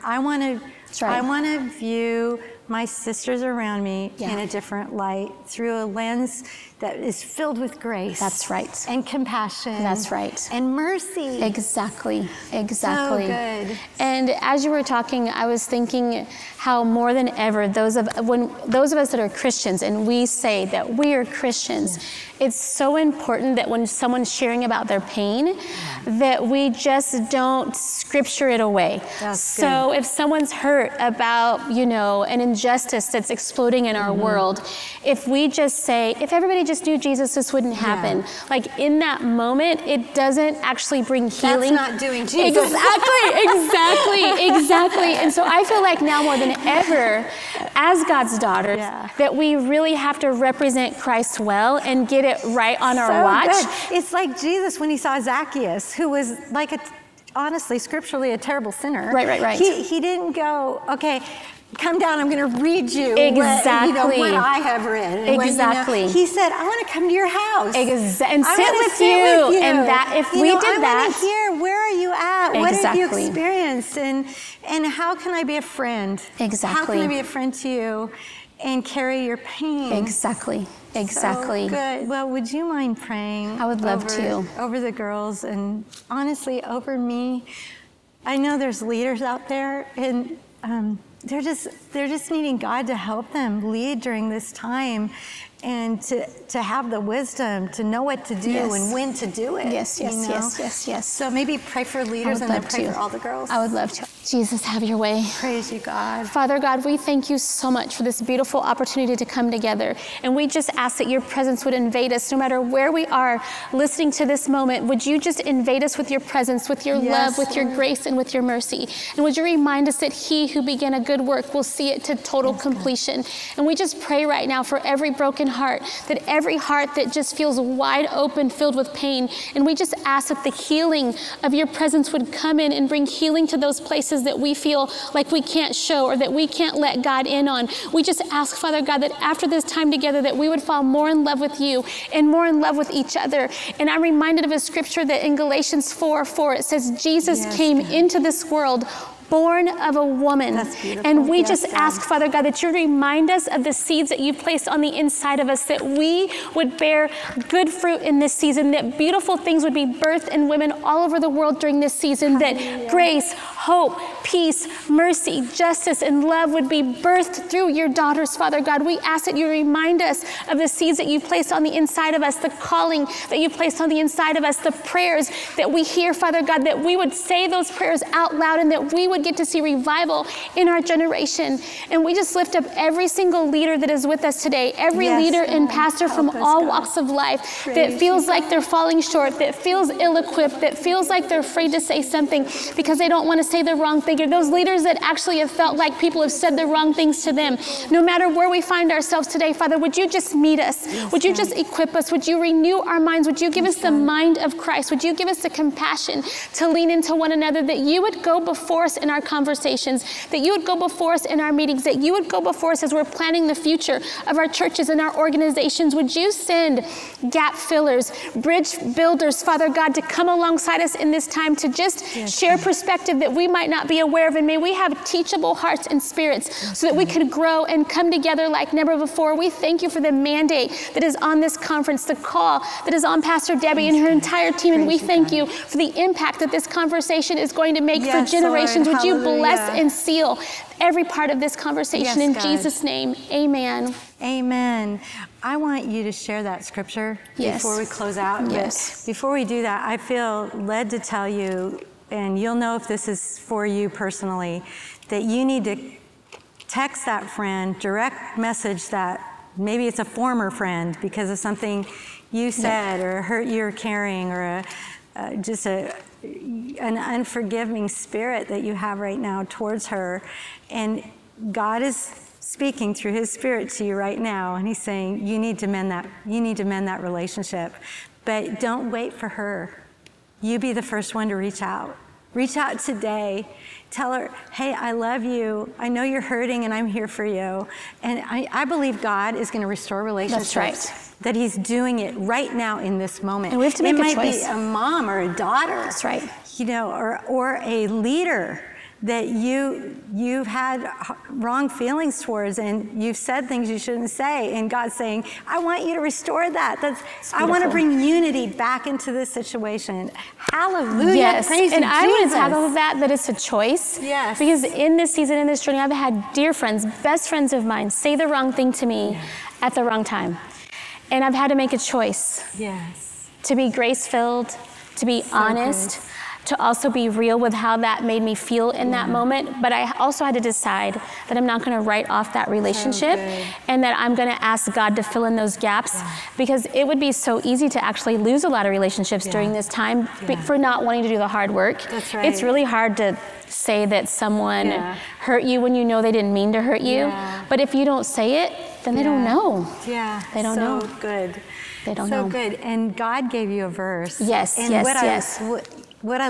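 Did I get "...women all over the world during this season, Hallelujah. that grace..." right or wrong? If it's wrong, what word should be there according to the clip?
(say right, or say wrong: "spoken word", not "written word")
right.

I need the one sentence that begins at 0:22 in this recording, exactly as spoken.
it's so important that when someone's sharing about their pain, that we just don't scripture it away.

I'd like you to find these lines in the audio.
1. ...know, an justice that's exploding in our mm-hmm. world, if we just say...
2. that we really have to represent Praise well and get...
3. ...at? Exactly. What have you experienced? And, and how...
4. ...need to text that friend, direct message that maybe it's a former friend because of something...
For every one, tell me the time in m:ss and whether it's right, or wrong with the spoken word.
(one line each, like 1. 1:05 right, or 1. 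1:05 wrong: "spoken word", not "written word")
1. 0:31 wrong: "injustice", not "justice"
2. 0:49 wrong: "Christ", not "Praise"
3. 1:12 right
4. 4:15 right.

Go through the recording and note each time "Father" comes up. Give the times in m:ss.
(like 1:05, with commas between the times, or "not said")
1:46, 2:18, 2:32, 2:48, 2:56, 3:19, 3:39.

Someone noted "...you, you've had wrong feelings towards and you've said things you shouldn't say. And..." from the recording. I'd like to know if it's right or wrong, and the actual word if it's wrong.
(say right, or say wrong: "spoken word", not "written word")
right.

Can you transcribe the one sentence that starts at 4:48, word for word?
And I, I believe God is going to restore relationships.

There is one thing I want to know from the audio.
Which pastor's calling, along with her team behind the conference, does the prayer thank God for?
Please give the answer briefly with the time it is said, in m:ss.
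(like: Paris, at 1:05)
Pastor Debbie, at 3:53.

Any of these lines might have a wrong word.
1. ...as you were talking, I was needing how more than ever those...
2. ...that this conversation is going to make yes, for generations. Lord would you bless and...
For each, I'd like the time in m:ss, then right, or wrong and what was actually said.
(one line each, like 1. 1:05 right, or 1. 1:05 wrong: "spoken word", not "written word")
1. 0:14 wrong: "thinking", not "needing"
2. 3:56 right.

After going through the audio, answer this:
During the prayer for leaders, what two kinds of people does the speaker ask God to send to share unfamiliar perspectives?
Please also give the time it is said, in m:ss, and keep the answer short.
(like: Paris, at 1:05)
gap fillers, bridge builders, at 3:37.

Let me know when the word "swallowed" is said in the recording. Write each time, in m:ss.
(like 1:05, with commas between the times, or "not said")
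not said.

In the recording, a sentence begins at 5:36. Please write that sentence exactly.
because it would be so easy to actually lose a lot of relationships yeah.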